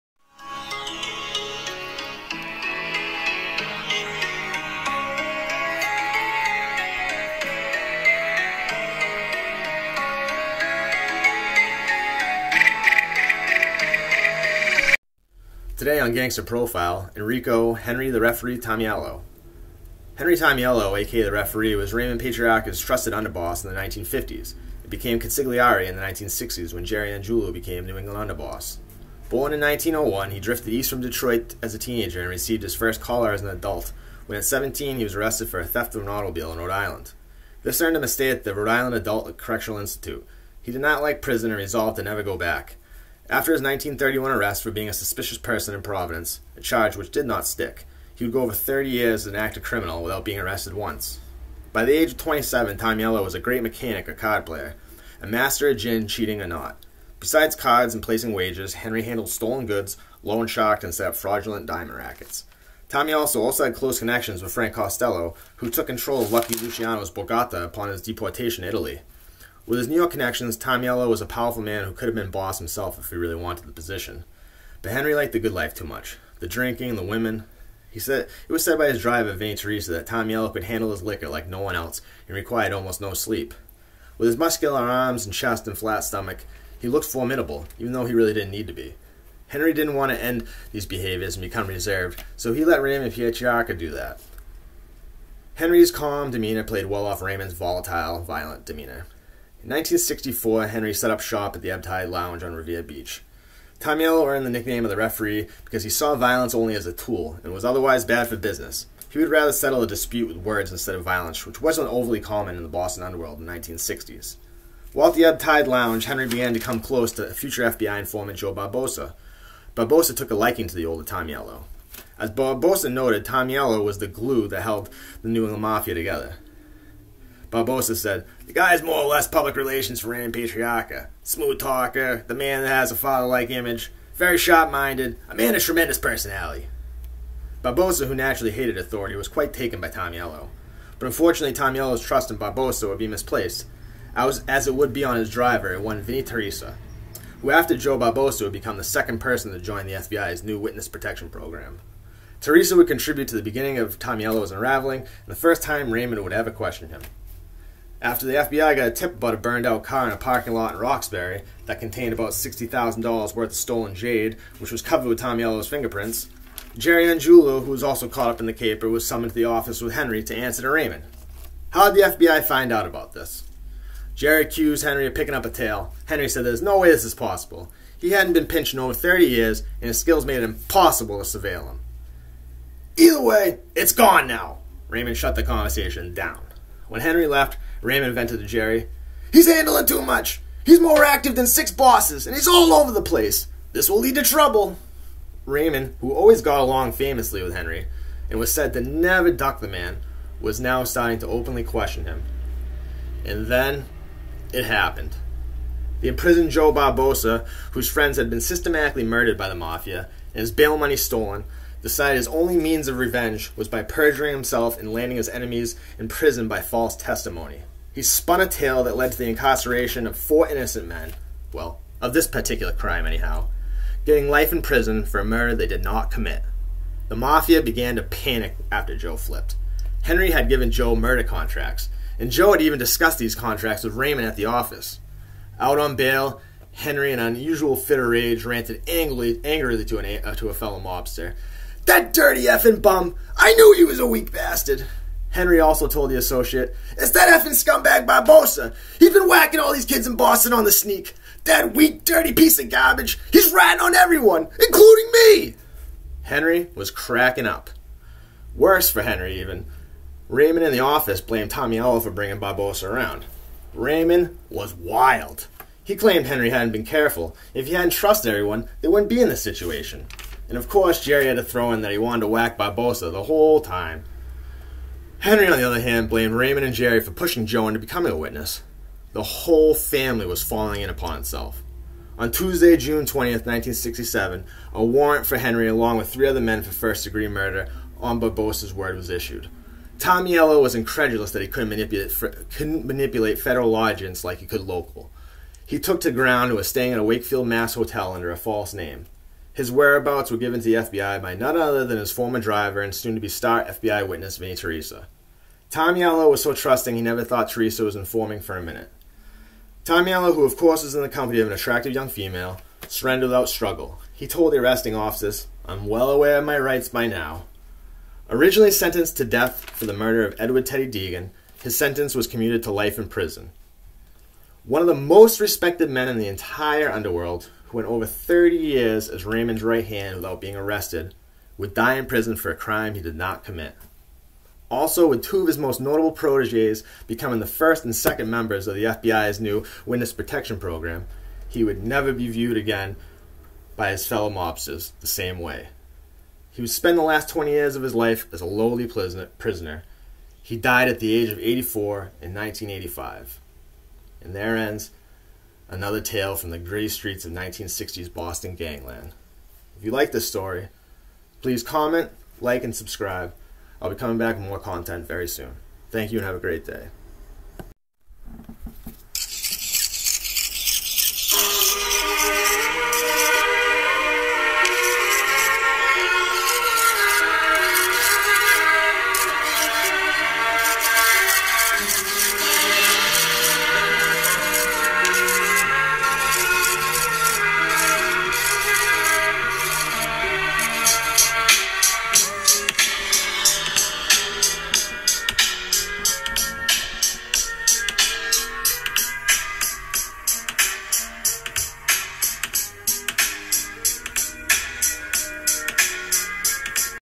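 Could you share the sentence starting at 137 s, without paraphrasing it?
Barboza, who naturally hated authority, was quite taken by Tameleo.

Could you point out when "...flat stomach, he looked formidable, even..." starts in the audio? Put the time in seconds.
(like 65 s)
85 s.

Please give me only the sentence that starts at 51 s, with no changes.
By the age of 27, Yellow was a great mechanic or card player, a master at gin, cheating, or not.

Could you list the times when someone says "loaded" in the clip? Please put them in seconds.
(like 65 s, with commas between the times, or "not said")
not said.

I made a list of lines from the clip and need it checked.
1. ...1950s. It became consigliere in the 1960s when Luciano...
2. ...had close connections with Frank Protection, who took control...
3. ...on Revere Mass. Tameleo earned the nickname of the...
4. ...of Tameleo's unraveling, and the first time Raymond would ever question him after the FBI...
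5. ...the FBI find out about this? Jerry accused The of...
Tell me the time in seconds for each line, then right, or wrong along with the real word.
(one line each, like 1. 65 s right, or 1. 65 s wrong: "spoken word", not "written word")
1. 23 s wrong: "Jerry", not "Luciano"
2. 63 s wrong: "Costello", not "Protection"
3. 102 s wrong: "Beach", not "Mass"
4. 153 s right
5. 171 s wrong: "Henry", not "The".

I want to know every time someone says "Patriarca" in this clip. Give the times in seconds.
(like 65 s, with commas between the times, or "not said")
22 s, 93 s, 130 s.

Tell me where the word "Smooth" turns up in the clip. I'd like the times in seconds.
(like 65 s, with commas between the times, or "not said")
131 s.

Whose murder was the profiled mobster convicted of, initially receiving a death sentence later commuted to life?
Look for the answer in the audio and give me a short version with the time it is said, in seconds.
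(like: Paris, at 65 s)
Edward Teddy Deegan, at 320 s.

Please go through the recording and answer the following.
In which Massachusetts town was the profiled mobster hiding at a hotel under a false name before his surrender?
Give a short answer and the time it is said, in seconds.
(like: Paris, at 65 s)
Wakefield, at 297 s.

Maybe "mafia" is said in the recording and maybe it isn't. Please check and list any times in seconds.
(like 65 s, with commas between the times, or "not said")
125 s, 209 s, 227 s.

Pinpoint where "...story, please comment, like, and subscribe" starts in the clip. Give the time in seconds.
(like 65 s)
360 s.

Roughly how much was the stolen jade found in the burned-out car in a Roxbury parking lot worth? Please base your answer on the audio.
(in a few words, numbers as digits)
$60,000.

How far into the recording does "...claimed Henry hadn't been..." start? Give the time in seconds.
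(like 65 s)
265 s.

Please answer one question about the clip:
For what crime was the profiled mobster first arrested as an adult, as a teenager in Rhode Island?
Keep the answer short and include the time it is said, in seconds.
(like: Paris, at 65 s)
Theft of an automobile, at 35 s.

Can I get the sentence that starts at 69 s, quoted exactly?
With his New York connections, Tameleo was a powerful man who could have been boss himself if he really wanted the position.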